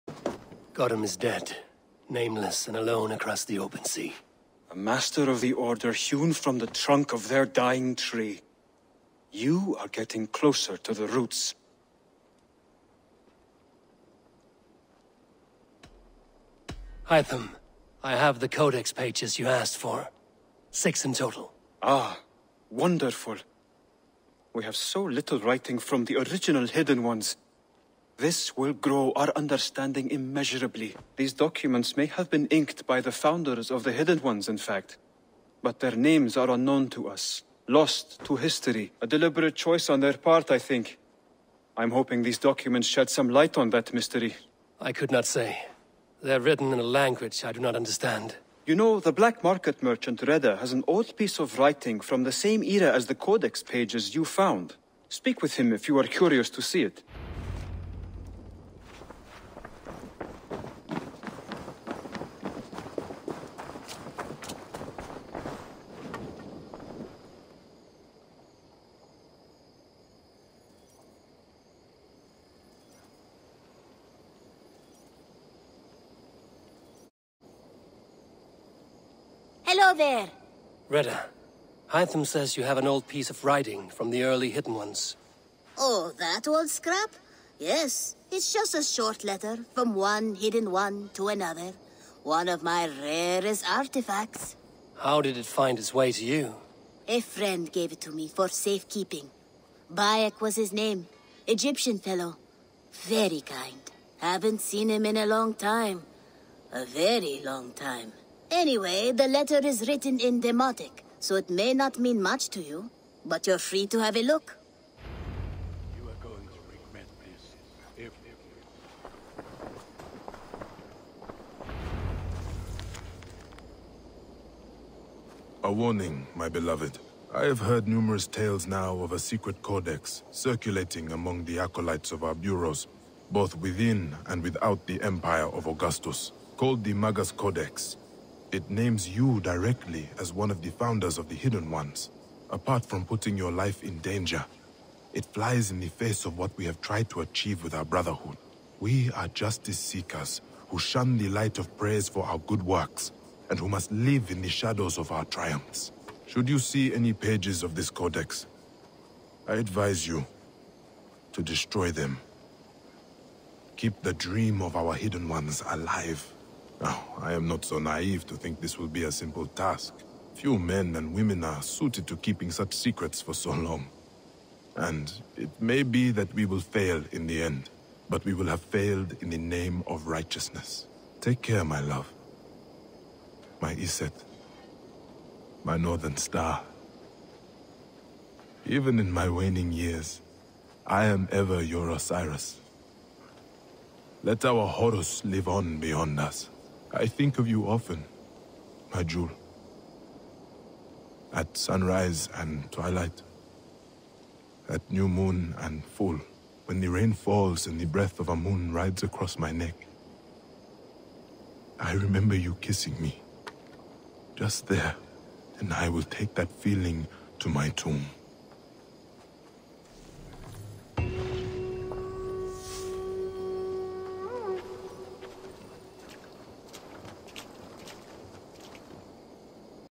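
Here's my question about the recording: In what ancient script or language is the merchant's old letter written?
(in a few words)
Demotic.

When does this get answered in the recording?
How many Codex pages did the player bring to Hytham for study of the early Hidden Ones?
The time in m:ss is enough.
0:20.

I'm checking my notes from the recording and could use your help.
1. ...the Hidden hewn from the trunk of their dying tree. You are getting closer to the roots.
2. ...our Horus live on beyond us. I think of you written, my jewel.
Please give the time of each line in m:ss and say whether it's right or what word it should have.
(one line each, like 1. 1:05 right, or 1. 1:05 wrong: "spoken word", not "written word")
1. 0:05 wrong: "Order", not "Hidden"
2. 3:14 wrong: "often", not "written".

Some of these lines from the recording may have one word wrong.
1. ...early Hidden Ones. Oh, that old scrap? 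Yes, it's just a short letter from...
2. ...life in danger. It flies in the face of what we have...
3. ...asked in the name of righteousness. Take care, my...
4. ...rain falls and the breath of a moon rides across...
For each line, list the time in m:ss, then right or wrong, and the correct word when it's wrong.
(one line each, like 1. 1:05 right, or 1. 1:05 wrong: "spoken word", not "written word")
1. 1:24 right
2. 2:23 right
3. 2:58 wrong: "failed", not "asked"
4. 3:26 right.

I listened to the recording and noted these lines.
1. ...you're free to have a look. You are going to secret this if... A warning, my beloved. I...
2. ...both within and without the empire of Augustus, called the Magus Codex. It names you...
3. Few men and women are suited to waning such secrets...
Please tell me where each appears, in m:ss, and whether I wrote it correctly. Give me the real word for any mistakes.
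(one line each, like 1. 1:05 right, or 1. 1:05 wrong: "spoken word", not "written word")
1. 1:53 wrong: "regret", not "secret"
2. 2:13 right
3. 2:50 wrong: "keeping", not "waning".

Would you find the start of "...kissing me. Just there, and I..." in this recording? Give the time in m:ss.
3:32.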